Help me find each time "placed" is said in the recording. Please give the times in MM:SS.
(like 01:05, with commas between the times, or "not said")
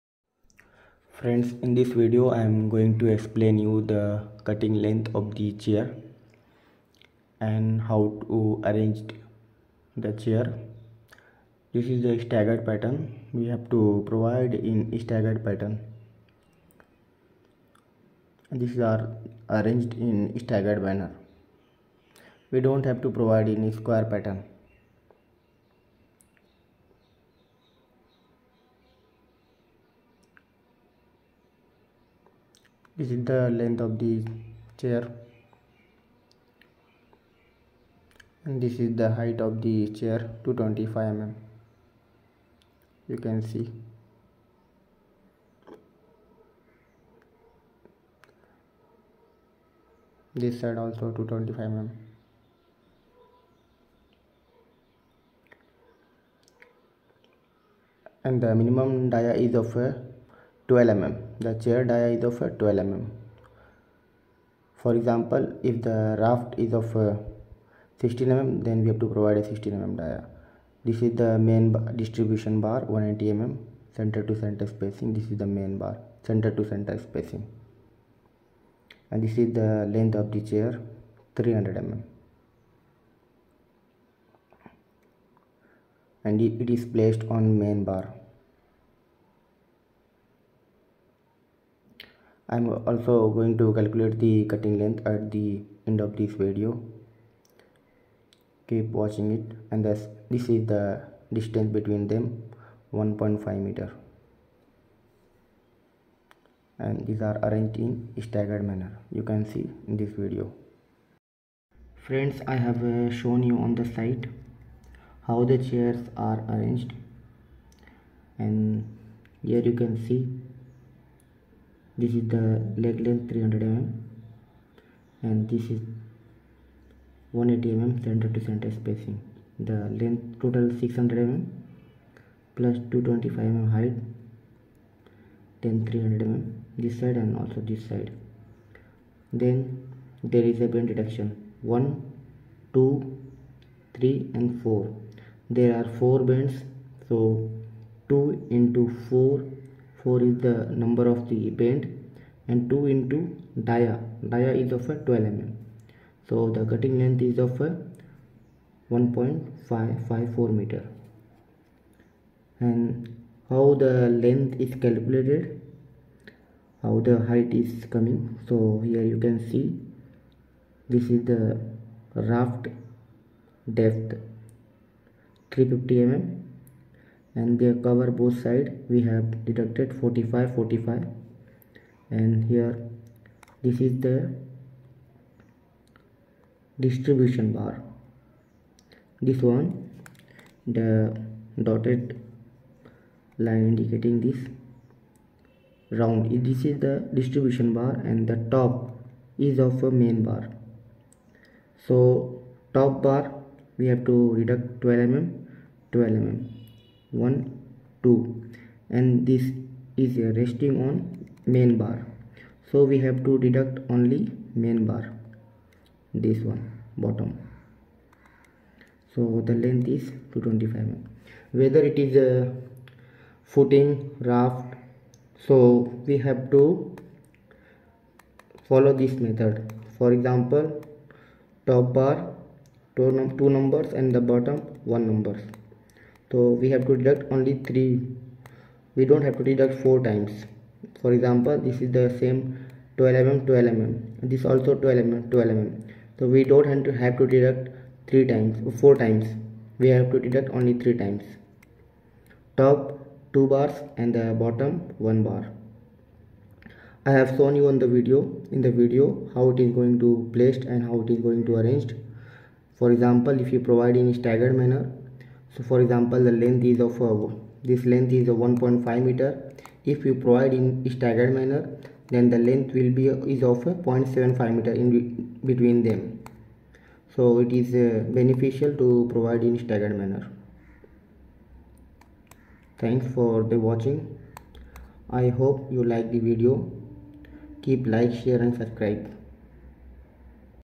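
01:26, 04:20.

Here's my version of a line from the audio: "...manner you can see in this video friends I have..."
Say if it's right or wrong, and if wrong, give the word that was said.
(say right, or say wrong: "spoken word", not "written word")
right.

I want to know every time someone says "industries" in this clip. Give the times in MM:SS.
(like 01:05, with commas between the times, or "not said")
not said.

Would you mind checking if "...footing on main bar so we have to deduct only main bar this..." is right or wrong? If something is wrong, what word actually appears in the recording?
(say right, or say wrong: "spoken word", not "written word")
wrong: "resting", not "footing".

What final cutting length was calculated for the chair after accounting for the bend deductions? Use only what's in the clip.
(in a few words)
1.554 meters.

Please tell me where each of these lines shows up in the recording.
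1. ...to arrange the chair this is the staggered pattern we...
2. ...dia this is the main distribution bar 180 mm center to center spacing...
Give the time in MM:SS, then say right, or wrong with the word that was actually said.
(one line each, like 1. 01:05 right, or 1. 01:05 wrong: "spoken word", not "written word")
1. 00:08 right
2. 01:10 right.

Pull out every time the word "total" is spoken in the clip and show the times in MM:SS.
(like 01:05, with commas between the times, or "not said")
02:10.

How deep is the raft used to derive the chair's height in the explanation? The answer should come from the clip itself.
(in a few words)
350 mm.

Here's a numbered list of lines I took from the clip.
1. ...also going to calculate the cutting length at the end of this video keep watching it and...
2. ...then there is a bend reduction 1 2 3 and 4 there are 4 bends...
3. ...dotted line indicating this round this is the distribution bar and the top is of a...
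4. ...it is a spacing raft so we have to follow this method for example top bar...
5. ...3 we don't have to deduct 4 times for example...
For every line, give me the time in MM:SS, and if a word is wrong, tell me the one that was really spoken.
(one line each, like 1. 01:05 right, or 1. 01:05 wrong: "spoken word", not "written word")
1. 01:32 right
2. 02:19 right
3. 03:11 right
4. 03:41 wrong: "footing", not "spacing"
5. 03:57 right.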